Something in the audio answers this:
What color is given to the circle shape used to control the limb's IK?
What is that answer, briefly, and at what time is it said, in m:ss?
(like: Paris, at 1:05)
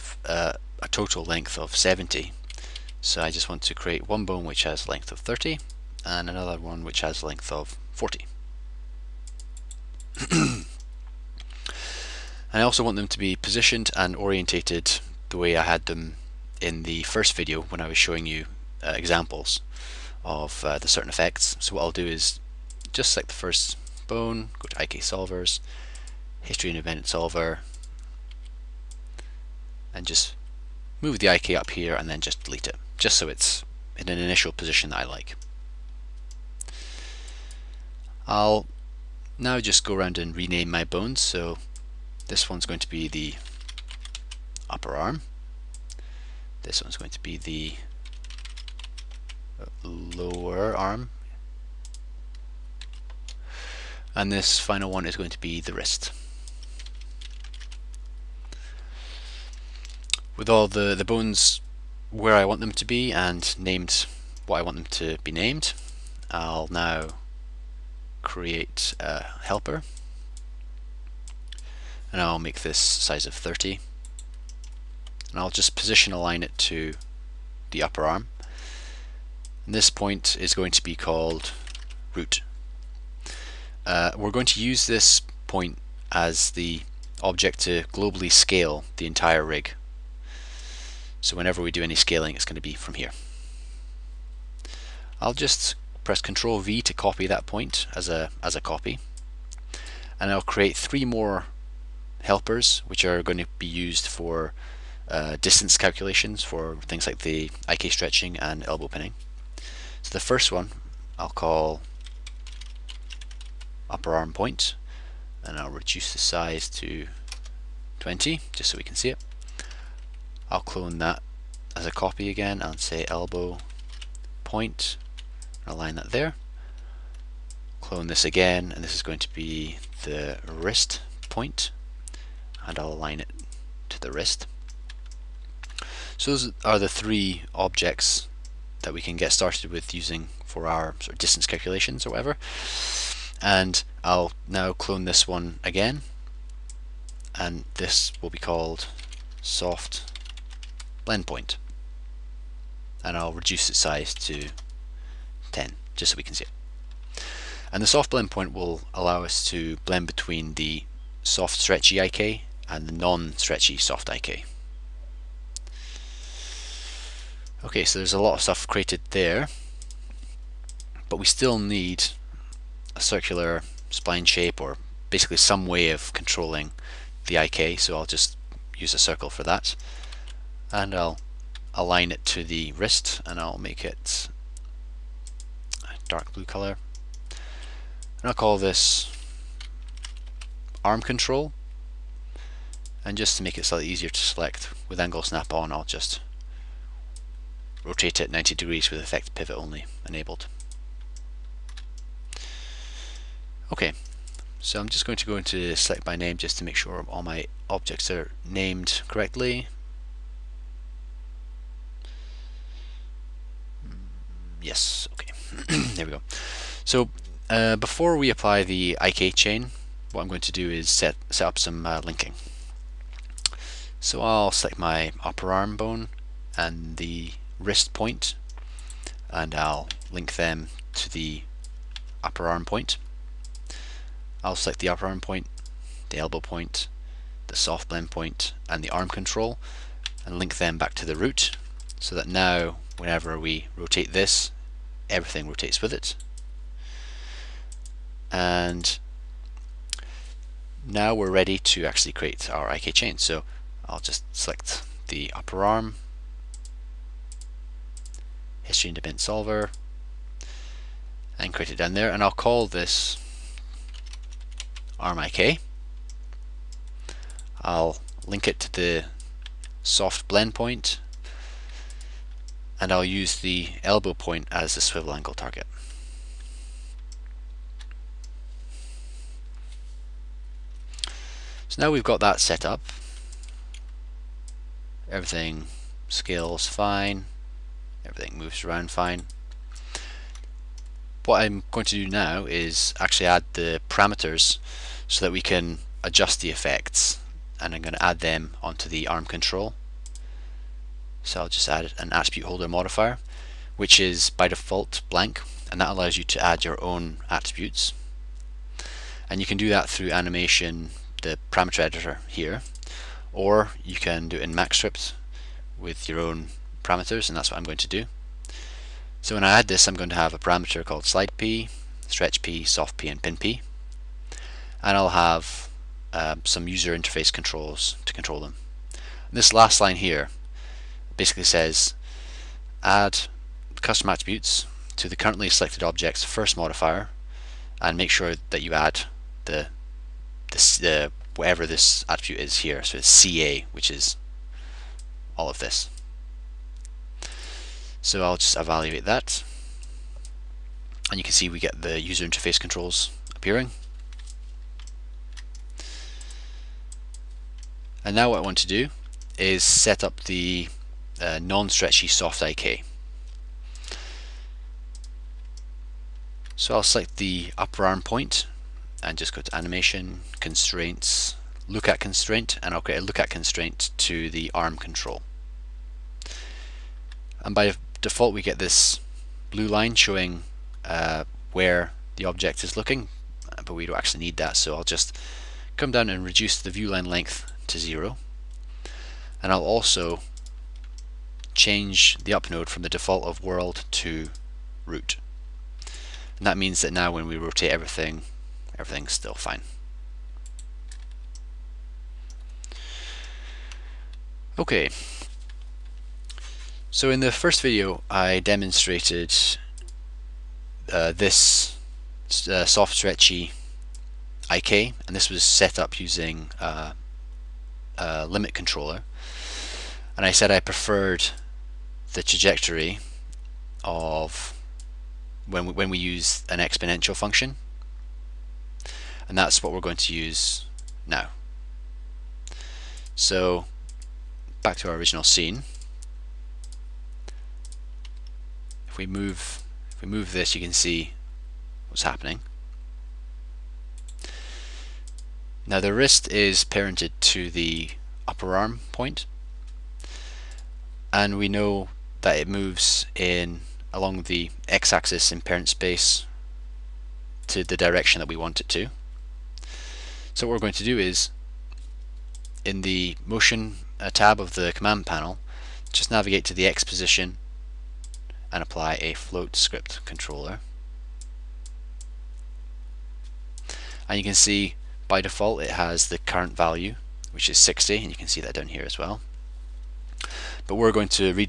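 dark blue, at 3:06.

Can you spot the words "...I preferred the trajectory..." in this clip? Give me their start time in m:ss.
7:00.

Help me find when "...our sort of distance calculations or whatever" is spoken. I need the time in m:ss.
2:20.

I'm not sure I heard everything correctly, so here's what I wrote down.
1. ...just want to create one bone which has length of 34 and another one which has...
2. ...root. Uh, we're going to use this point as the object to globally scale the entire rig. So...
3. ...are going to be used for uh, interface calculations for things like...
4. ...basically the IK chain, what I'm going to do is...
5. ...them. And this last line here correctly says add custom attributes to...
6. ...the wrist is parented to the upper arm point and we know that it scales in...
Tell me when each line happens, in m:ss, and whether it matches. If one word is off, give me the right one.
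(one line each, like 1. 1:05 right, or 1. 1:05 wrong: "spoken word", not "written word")
1. 0:03 wrong: "30", not "34"
2. 1:22 right
3. 1:43 wrong: "distance", not "interface"
4. 3:38 wrong: "apply", not "basically"
5. 5:28 wrong: "basically", not "correctly"
6. 7:25 wrong: "moves", not "scales".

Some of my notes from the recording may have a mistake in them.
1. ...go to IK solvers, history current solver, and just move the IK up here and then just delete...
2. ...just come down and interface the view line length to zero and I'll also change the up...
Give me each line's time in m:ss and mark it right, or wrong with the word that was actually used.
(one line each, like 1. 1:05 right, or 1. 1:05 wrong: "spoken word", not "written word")
1. 0:24 wrong: "independent", not "current"
2. 6:24 wrong: "reduce", not "interface".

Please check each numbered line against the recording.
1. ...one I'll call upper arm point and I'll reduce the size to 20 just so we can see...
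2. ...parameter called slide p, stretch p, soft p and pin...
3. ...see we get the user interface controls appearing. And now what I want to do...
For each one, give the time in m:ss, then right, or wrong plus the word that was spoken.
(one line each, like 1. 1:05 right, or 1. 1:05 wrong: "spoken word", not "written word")
1. 1:50 right
2. 5:20 right
3. 5:51 right.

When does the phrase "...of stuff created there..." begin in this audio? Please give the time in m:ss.
2:48.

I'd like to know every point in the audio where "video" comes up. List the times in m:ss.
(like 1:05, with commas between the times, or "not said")
0:17, 6:47.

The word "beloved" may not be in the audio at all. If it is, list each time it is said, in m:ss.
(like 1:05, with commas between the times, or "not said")
not said.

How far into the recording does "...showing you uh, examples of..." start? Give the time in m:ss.
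0:17.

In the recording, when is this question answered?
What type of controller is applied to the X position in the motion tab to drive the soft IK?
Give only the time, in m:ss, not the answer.
7:49.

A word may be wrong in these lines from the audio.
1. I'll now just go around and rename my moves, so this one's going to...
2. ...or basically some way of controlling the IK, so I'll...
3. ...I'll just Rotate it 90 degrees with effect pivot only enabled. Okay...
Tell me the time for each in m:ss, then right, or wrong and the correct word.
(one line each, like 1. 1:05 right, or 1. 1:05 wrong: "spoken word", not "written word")
1. 0:38 wrong: "bones", not "moves"
2. 2:54 right
3. 3:15 right.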